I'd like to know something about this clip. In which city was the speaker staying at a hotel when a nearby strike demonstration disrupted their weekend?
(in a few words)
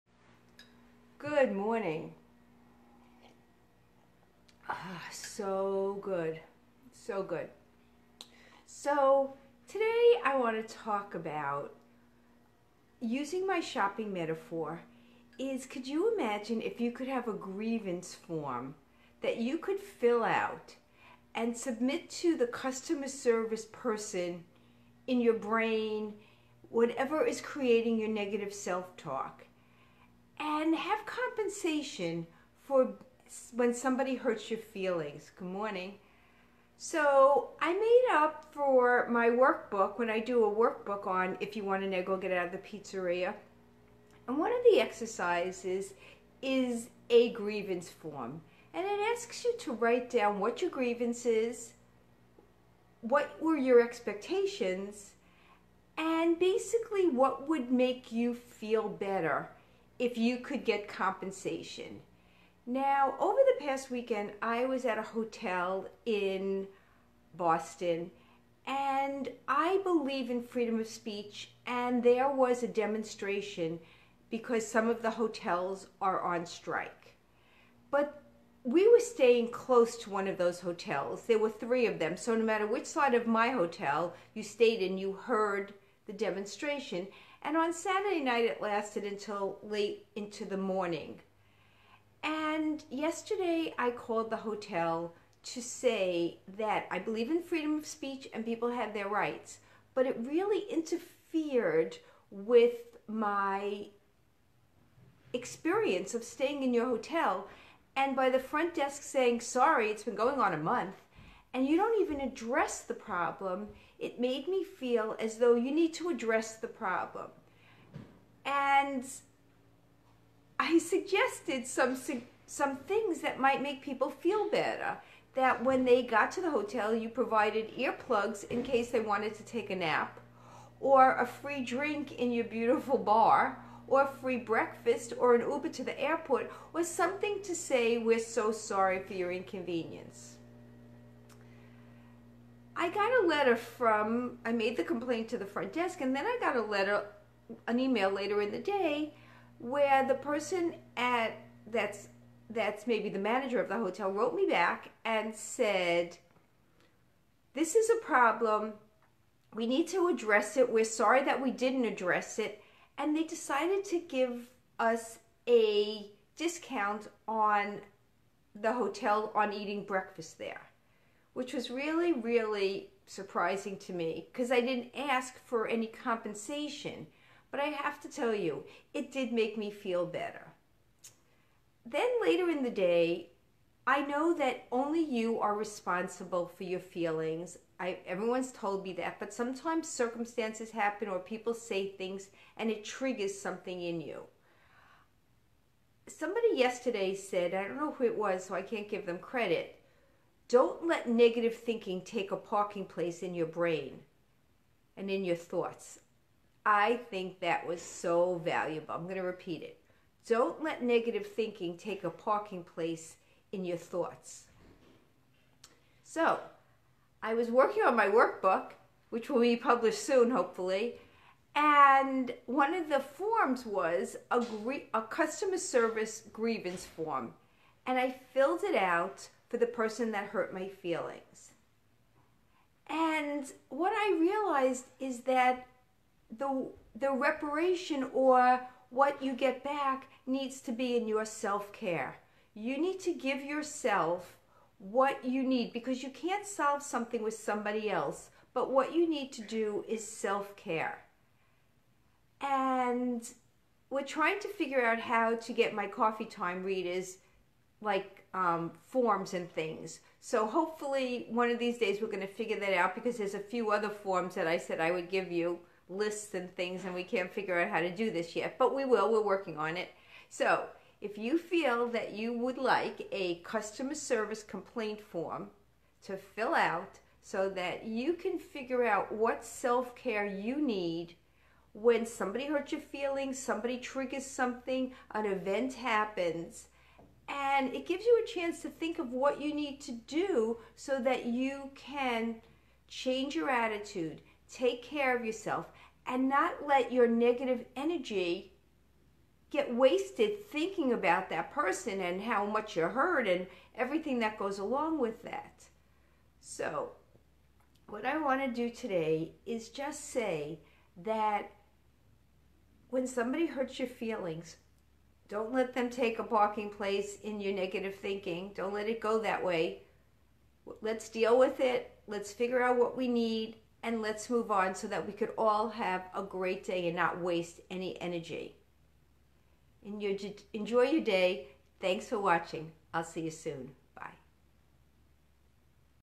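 Boston.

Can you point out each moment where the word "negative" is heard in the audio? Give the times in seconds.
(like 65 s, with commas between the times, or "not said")
28 s, 201 s, 210 s, 297 s, 317 s.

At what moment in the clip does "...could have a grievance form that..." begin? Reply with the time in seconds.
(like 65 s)
16 s.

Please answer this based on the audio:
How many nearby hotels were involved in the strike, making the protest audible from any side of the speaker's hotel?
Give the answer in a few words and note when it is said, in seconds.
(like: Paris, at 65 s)
3, at 81 s.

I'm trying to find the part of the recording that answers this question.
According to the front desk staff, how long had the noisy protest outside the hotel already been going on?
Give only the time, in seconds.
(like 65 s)
110 s.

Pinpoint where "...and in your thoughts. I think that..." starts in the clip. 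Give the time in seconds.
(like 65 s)
204 s.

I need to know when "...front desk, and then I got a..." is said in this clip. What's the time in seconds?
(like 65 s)
145 s.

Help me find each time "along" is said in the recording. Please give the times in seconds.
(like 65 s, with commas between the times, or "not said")
304 s.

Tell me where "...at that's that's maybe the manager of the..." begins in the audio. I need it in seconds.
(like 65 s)
150 s.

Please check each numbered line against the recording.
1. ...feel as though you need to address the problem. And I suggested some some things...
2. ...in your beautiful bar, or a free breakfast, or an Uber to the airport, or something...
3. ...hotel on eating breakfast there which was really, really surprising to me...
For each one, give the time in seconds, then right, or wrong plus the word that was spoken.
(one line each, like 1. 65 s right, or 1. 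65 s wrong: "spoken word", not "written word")
1. 114 s right
2. 132 s right
3. 168 s right.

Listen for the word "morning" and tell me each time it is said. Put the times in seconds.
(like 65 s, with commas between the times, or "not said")
1 s, 35 s, 90 s.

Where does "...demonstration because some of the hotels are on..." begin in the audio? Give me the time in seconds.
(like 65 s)
72 s.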